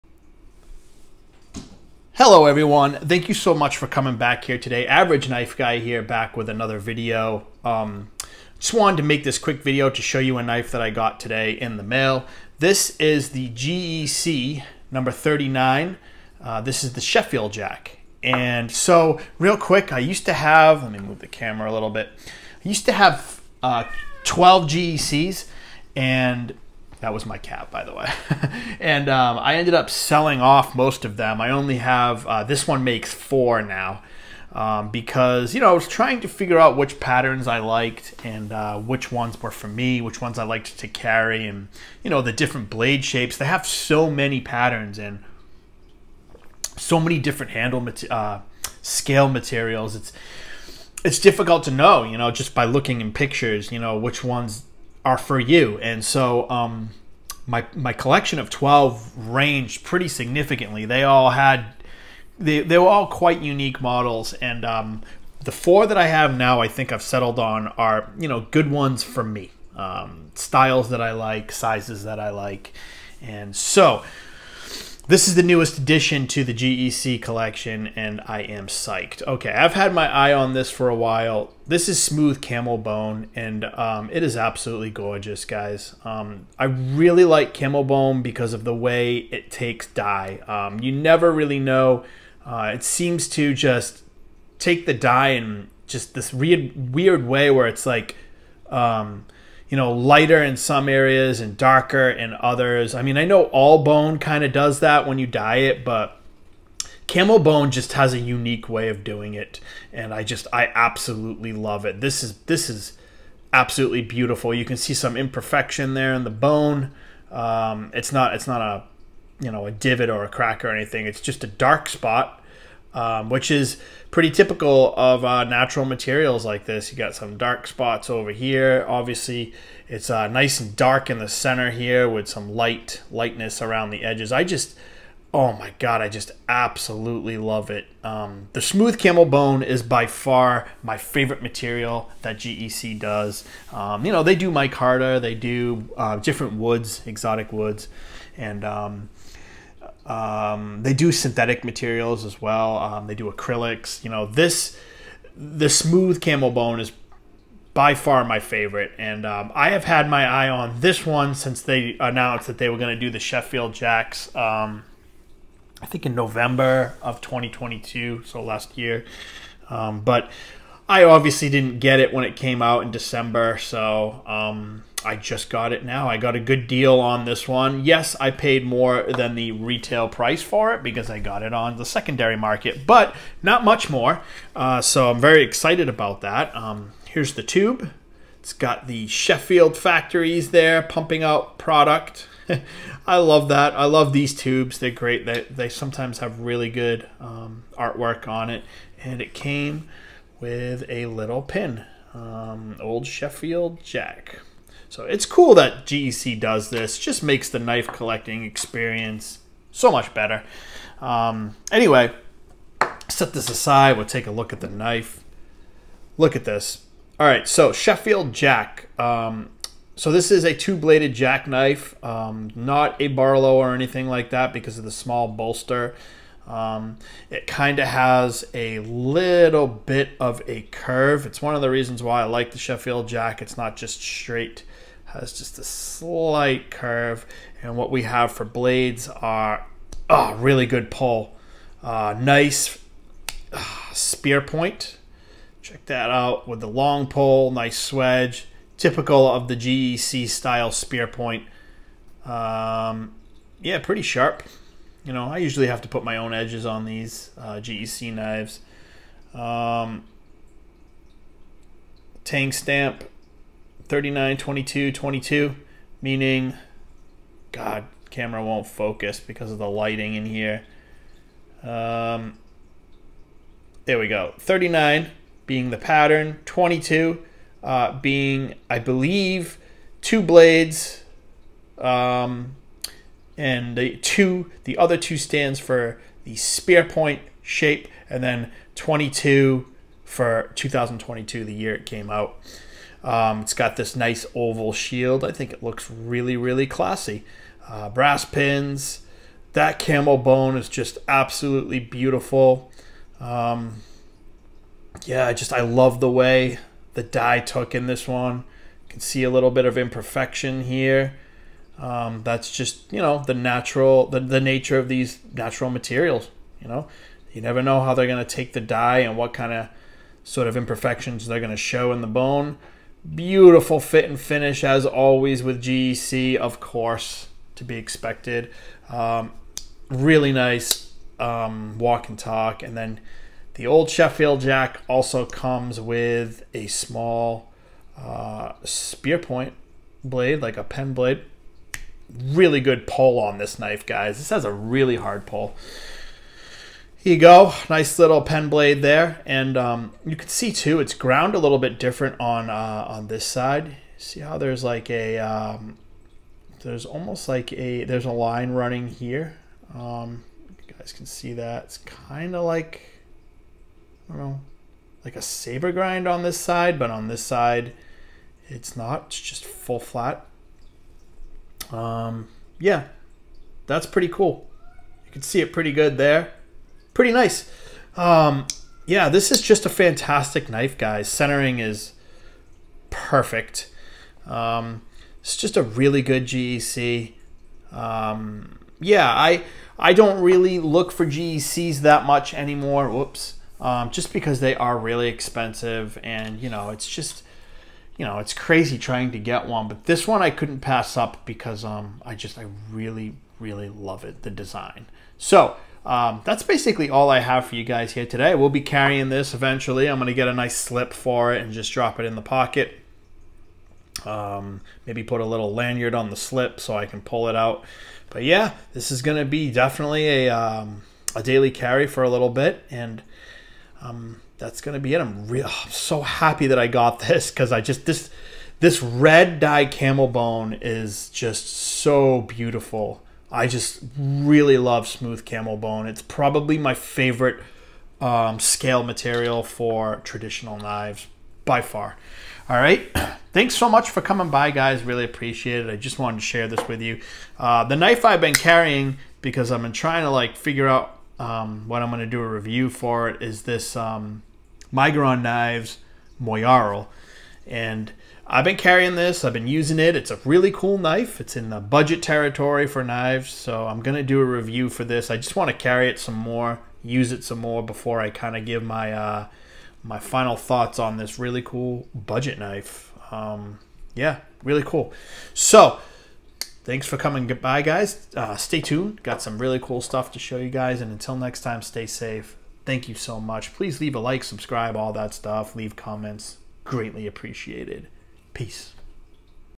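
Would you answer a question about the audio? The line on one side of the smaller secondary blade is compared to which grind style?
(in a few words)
saber grind.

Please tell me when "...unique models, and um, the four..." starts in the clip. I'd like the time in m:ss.
1:03.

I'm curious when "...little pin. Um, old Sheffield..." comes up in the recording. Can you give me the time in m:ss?
3:21.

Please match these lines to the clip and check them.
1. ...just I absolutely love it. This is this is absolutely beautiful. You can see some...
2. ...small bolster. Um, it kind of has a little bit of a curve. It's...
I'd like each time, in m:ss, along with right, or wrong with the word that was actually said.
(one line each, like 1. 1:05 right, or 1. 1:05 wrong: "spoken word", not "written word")
1. 1:50 right
2. 3:44 right.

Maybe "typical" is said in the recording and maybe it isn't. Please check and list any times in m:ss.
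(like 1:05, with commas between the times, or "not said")
2:04, 4:08.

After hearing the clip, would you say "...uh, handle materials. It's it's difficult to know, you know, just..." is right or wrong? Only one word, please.
wrong.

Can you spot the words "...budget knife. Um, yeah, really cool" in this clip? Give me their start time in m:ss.
7:51.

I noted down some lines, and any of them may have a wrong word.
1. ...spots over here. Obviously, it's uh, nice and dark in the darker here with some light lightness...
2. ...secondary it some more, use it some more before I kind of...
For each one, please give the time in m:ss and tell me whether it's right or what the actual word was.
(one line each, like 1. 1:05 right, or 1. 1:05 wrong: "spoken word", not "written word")
1. 2:07 wrong: "center", not "darker"
2. 7:45 wrong: "carry", not "secondary".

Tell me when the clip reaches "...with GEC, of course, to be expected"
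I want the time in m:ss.
5:25.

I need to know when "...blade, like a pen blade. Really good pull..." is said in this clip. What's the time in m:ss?
5:40.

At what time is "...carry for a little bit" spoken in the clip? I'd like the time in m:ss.
7:01.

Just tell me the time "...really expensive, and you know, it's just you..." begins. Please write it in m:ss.
6:34.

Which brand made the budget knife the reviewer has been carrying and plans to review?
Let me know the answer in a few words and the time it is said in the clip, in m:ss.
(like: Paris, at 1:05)
Migron Knives, at 7:34.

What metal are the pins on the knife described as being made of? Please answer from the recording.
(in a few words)
brass.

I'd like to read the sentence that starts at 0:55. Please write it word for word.
And so um, my my collection of twelve ranged pretty significantly.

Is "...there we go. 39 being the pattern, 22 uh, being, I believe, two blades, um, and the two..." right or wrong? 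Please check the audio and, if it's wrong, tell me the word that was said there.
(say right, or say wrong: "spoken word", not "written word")
right.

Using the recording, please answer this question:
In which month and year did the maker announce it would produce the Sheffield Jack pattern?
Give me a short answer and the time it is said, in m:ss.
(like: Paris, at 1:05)
November 2022, at 2:46.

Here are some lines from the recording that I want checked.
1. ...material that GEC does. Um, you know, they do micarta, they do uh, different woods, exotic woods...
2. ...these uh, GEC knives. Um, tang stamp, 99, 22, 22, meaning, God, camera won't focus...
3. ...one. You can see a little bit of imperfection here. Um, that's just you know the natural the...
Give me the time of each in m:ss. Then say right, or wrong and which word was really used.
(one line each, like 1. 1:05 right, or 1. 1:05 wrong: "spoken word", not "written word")
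1. 2:21 right
2. 4:16 wrong: "39", not "99"
3. 5:08 right.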